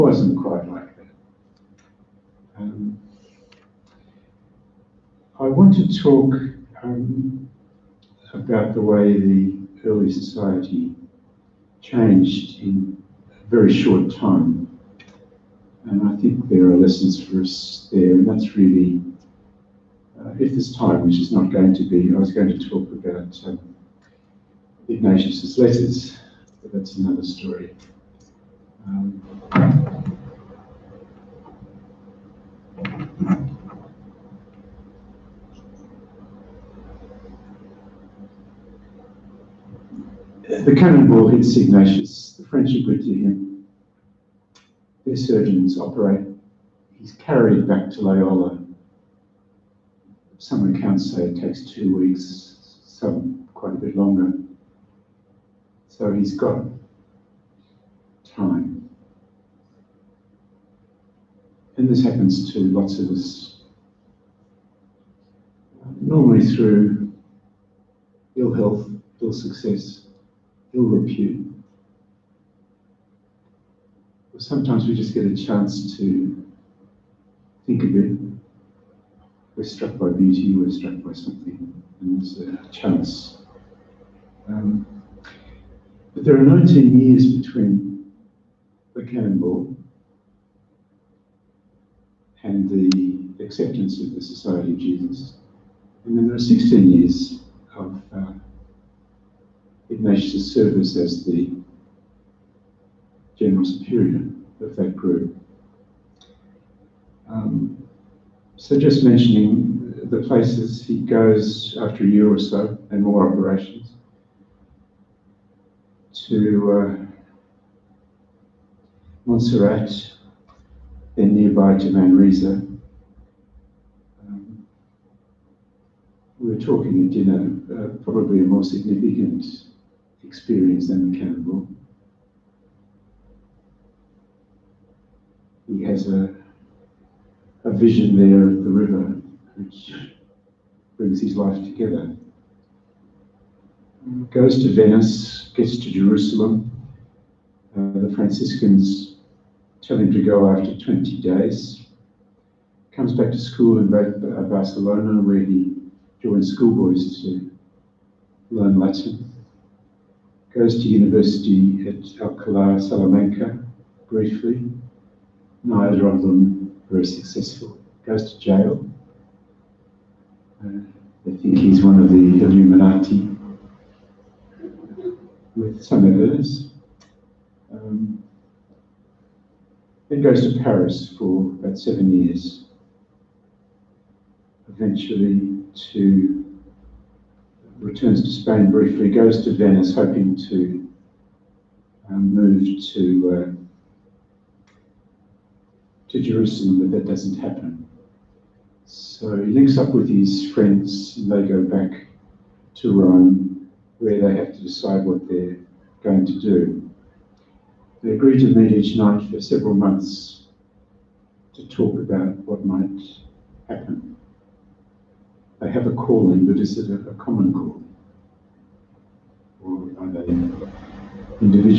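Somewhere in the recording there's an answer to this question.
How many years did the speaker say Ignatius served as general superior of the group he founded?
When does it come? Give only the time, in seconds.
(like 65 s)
96 s.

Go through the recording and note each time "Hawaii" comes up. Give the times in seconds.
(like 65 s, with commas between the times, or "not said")
not said.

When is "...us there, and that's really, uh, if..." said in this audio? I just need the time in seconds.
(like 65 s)
17 s.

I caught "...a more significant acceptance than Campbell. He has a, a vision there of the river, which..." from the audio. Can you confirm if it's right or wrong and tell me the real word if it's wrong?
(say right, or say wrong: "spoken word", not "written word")
wrong: "experience", not "acceptance".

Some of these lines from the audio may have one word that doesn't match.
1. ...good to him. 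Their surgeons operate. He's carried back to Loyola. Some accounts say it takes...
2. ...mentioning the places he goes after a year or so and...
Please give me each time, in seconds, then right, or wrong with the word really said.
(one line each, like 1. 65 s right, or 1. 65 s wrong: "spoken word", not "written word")
1. 42 s right
2. 109 s right.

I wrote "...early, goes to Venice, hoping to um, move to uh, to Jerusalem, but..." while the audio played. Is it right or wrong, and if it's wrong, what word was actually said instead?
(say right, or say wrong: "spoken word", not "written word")
wrong: "briefly", not "early".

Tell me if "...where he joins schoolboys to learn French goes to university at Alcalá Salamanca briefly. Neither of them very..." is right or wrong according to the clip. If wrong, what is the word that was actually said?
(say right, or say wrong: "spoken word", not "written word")
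wrong: "Latin", not "French".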